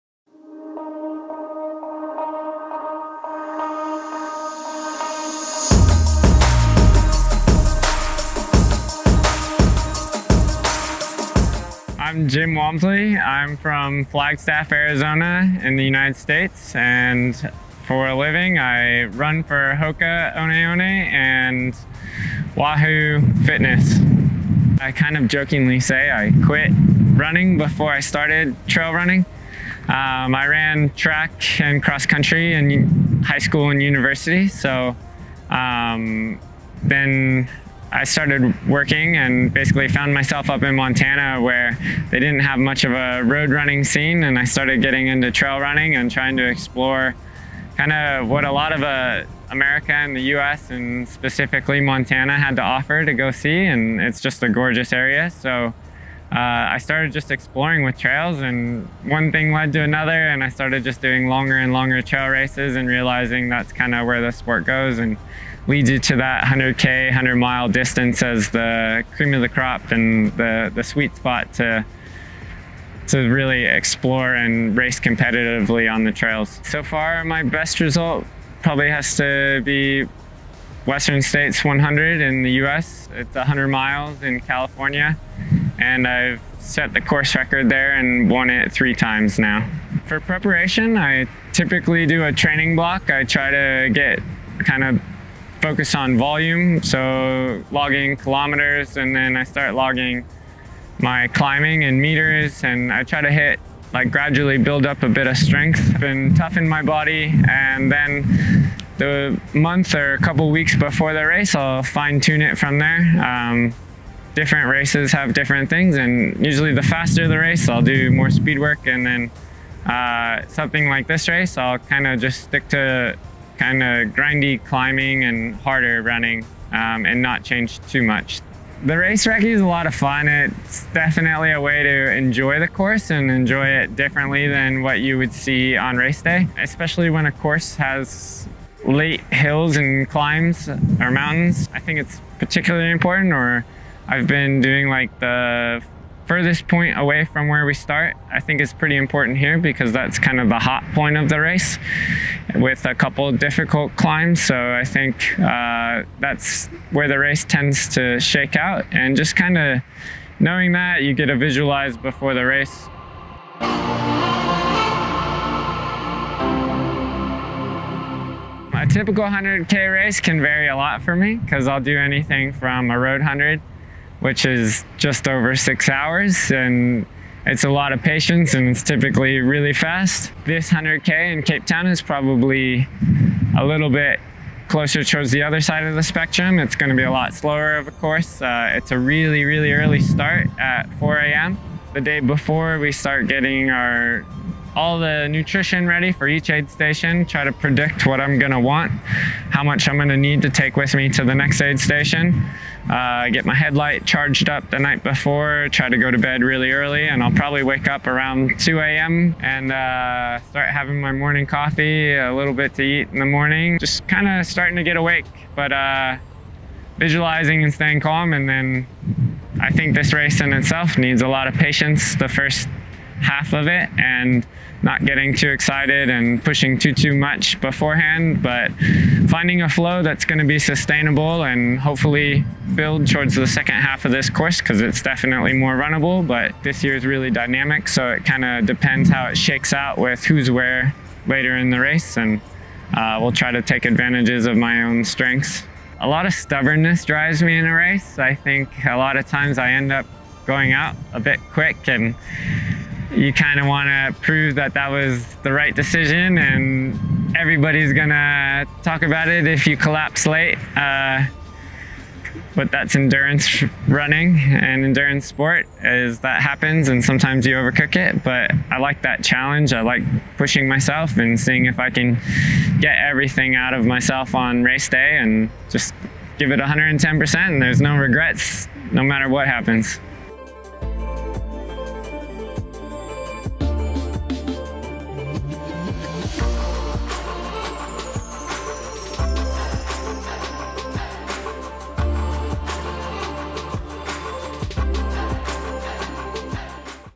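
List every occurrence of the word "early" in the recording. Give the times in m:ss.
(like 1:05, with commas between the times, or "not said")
3:09, 3:26.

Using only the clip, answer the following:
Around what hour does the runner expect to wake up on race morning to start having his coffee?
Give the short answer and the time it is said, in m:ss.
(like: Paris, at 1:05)
2 a.m., at 3:28.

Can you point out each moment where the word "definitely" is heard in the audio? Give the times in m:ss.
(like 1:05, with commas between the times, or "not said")
2:10, 3:55.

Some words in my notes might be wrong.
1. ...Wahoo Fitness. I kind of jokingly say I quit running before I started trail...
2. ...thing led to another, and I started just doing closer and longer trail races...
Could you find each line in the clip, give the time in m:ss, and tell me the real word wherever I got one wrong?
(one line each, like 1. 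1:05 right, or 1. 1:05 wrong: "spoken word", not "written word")
1. 0:22 right
2. 0:59 wrong: "longer", not "closer".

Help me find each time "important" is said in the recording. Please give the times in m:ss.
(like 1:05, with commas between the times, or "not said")
2:22, 2:28.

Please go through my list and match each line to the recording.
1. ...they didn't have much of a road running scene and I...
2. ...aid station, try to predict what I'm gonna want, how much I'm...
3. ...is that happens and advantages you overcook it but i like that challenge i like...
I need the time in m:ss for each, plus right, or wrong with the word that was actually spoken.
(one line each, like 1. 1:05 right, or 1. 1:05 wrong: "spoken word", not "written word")
1. 0:42 right
2. 3:16 right
3. 4:25 wrong: "sometimes", not "advantages".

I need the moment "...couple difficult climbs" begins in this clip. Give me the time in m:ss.
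2:32.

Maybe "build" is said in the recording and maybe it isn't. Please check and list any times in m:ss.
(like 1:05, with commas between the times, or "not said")
1:44, 3:52.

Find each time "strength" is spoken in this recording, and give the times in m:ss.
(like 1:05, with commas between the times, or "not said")
1:45, 4:05.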